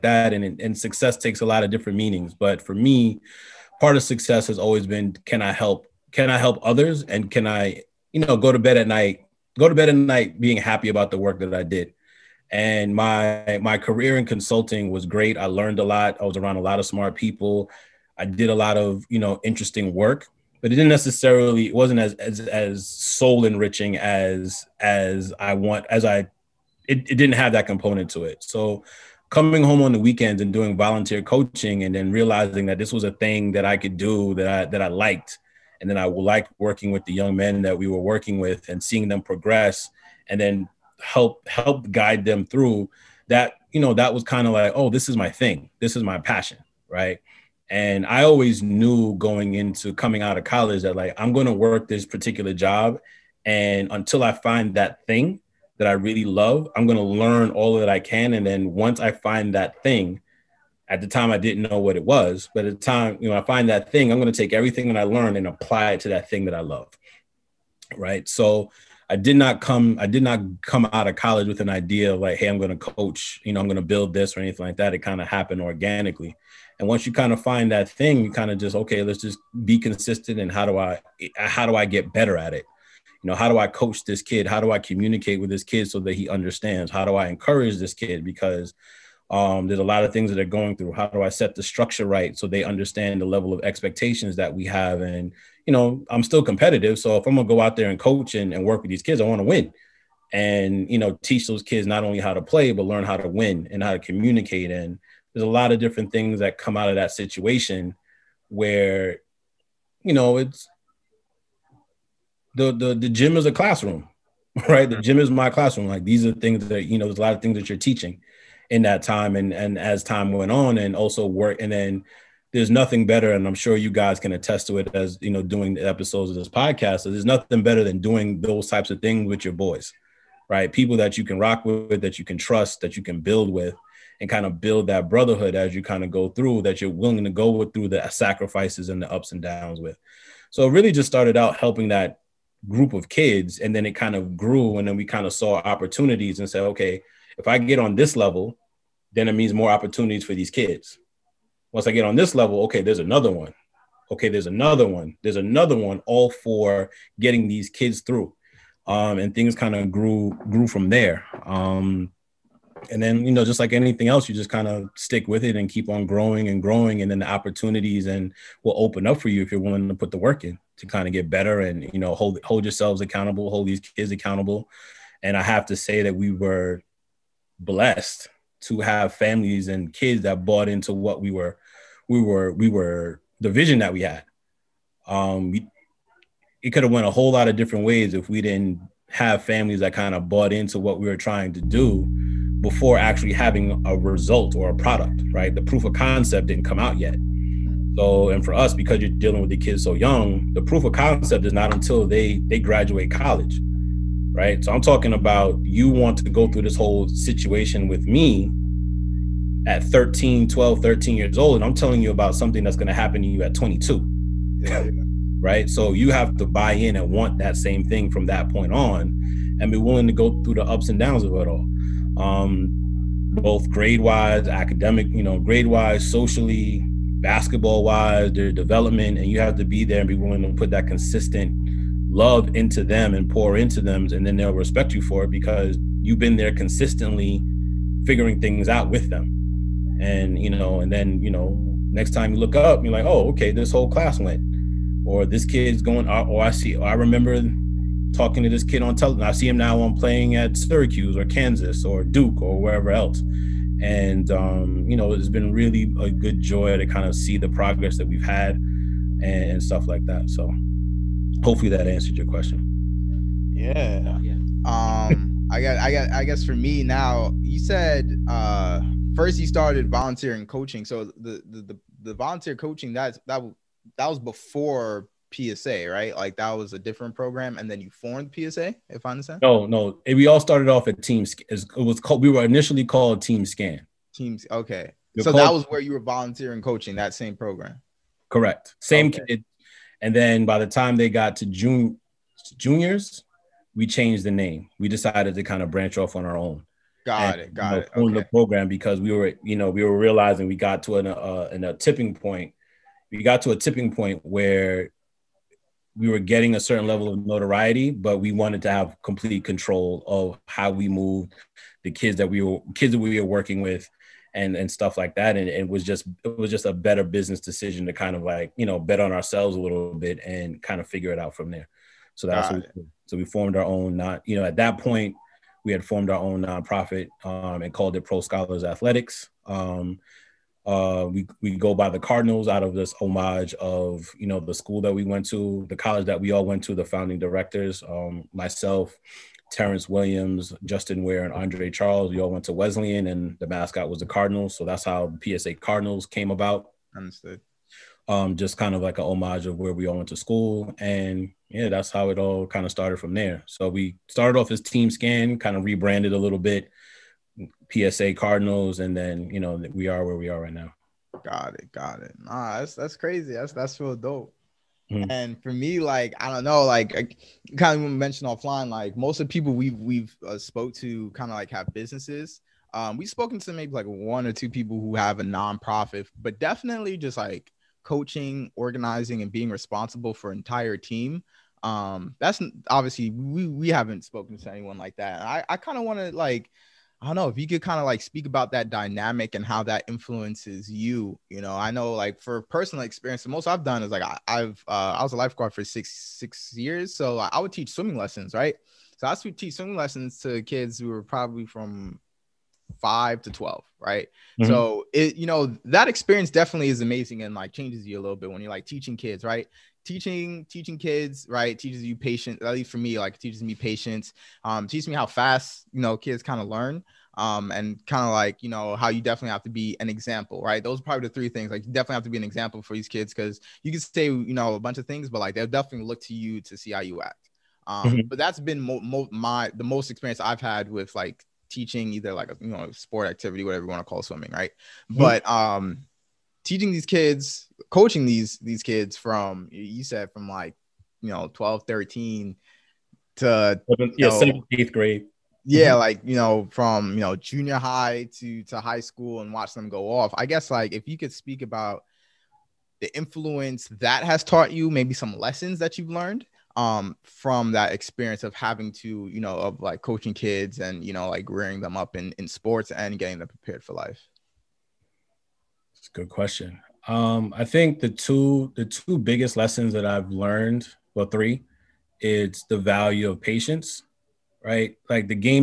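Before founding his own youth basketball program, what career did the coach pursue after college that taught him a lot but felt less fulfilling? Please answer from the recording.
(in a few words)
consulting.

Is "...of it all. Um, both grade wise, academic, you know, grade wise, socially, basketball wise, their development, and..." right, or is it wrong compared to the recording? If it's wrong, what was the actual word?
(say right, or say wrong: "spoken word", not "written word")
right.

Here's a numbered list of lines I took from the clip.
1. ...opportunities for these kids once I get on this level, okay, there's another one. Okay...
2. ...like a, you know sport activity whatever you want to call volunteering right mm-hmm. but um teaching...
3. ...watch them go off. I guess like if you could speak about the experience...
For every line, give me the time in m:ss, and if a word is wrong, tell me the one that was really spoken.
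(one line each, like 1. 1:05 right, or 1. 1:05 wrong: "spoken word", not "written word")
1. 2:29 right
2. 7:12 wrong: "swimming", not "volunteering"
3. 7:29 wrong: "influence", not "experience".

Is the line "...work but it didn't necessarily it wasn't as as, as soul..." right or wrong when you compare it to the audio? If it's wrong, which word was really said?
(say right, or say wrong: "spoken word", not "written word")
right.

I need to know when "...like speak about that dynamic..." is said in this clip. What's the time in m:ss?
6:27.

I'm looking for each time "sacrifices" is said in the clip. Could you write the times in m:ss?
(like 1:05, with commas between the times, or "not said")
2:18.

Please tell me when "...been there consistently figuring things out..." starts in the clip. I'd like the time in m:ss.
3:56.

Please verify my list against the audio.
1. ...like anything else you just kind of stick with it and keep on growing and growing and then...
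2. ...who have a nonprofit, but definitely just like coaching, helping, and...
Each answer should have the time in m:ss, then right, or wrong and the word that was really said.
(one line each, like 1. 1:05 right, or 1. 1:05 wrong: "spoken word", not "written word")
1. 2:43 right
2. 6:14 wrong: "organizing", not "helping".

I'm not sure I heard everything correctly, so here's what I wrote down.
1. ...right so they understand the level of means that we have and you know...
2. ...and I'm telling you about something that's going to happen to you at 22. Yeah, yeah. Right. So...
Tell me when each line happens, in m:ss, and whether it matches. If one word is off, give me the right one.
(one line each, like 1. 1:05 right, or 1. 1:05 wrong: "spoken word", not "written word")
1. 1:32 wrong: "expectations", not "means"
2. 3:31 right.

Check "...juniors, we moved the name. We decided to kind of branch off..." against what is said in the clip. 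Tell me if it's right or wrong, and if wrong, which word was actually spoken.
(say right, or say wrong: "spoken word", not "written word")
wrong: "changed", not "moved".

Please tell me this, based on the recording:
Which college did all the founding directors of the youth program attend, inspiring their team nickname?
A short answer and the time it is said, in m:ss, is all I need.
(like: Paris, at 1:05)
Wesleyan, at 5:42.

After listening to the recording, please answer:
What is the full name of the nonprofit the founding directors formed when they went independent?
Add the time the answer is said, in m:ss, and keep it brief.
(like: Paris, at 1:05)
Pro Scholars Athletics, at 5:28.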